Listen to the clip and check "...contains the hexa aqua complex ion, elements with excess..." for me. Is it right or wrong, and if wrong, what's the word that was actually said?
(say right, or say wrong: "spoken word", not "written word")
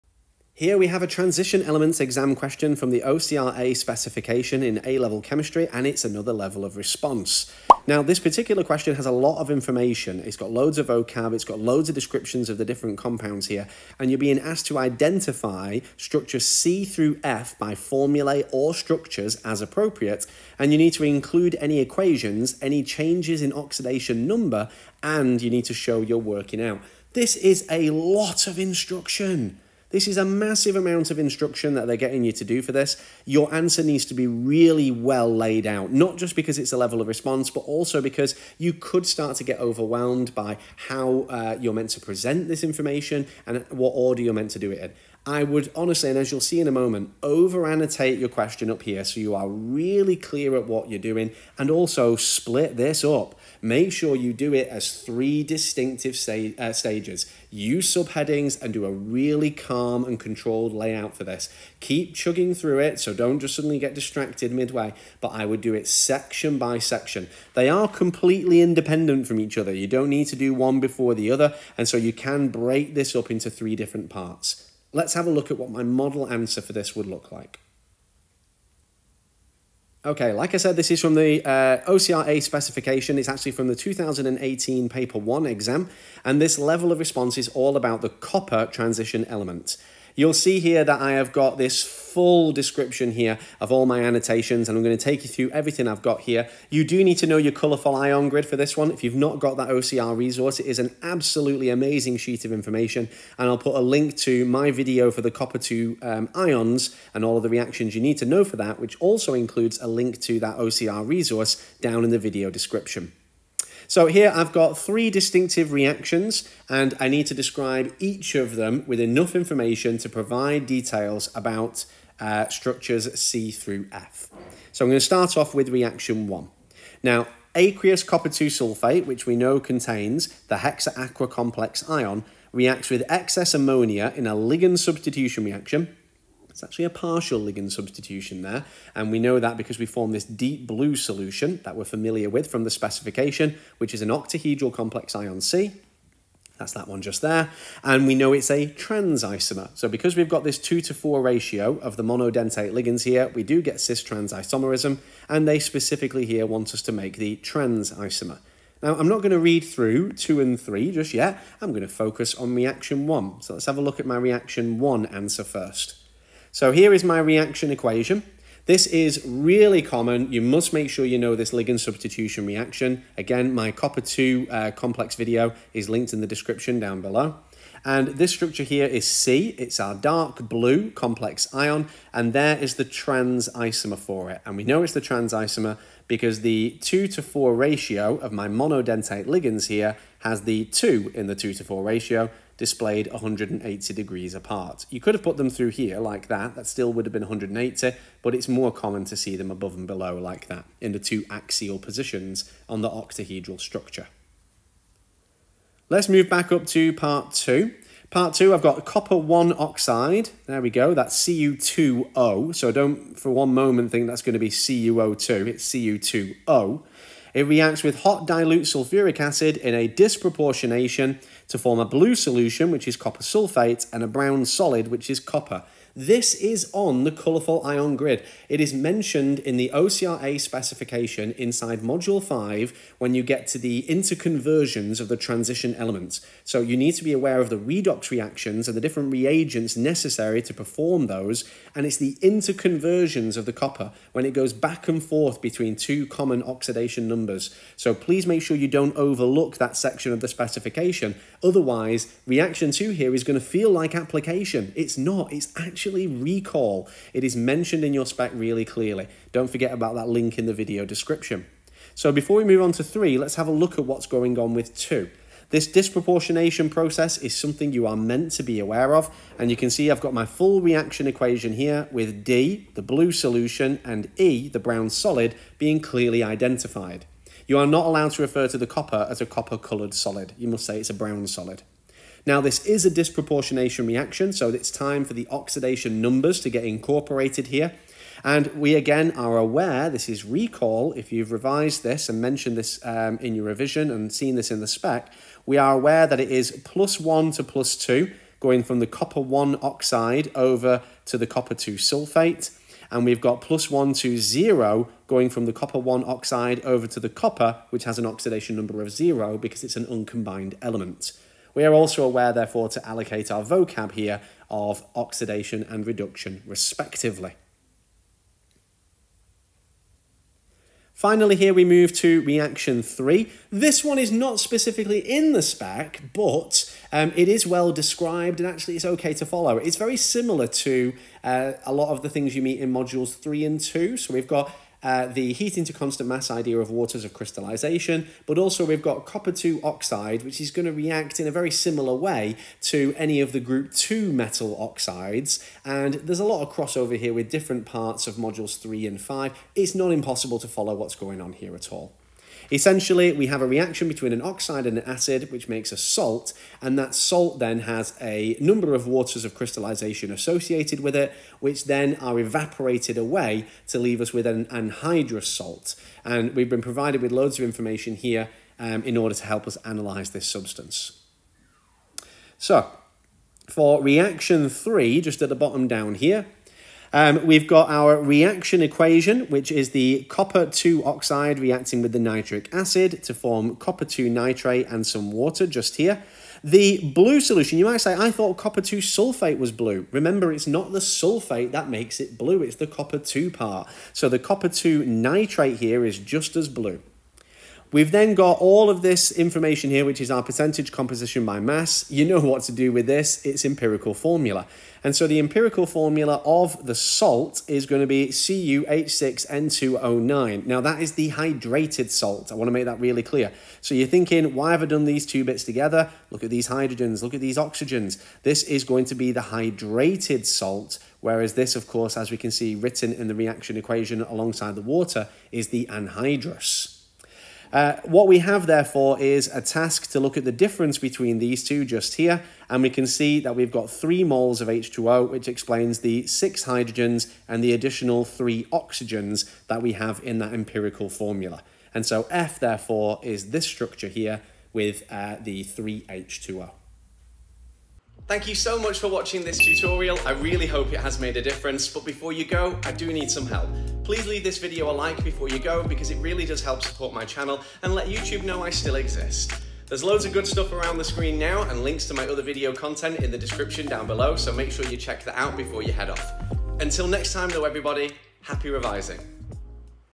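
wrong: "reacts", not "elements".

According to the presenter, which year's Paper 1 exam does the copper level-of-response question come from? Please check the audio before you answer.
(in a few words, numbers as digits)
2018.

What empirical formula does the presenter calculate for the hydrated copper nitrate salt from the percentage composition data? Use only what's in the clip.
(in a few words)
CuH6N2O9.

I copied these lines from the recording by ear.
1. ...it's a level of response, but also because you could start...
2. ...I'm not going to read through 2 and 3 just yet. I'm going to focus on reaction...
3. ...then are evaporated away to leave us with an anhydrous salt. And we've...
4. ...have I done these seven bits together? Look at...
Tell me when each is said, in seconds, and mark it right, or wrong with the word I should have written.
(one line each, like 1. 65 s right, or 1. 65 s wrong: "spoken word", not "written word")
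1. 36 s right
2. 158 s right
3. 361 s right
4. 414 s wrong: "two", not "seven".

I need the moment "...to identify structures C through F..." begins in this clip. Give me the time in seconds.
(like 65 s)
14 s.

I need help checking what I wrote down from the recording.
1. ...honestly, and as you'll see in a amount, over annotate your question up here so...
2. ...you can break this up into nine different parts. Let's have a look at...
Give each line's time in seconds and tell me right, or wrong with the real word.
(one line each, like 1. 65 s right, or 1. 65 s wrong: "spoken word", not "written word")
1. 45 s wrong: "moment", not "amount"
2. 71 s wrong: "three", not "nine".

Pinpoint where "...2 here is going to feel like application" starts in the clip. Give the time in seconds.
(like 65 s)
252 s.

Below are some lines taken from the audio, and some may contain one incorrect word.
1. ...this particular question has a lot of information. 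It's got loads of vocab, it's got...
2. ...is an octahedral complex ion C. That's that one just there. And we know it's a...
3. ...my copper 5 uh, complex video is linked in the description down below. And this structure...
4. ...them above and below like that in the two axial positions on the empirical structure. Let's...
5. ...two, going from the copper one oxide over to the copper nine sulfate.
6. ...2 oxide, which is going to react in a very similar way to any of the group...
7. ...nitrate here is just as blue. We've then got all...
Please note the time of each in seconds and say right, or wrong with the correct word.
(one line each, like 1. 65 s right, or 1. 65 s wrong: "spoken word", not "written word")
1. 8 s right
2. 143 s right
3. 173 s wrong: "2", not "5"
4. 199 s wrong: "octahedral", not "empirical"
5. 297 s wrong: "two", not "nine"
6. 339 s right
7. 394 s right.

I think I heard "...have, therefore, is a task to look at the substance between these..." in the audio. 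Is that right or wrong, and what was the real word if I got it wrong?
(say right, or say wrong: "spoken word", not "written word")
wrong: "difference", not "substance".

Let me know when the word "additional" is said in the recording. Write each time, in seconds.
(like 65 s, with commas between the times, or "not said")
437 s.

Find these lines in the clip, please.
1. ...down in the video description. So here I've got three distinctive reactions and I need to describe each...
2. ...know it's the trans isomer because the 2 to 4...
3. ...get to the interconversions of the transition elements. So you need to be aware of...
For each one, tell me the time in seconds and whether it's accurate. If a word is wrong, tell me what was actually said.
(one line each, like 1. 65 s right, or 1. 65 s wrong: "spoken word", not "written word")
1. 111 s right
2. 184 s right
3. 233 s right.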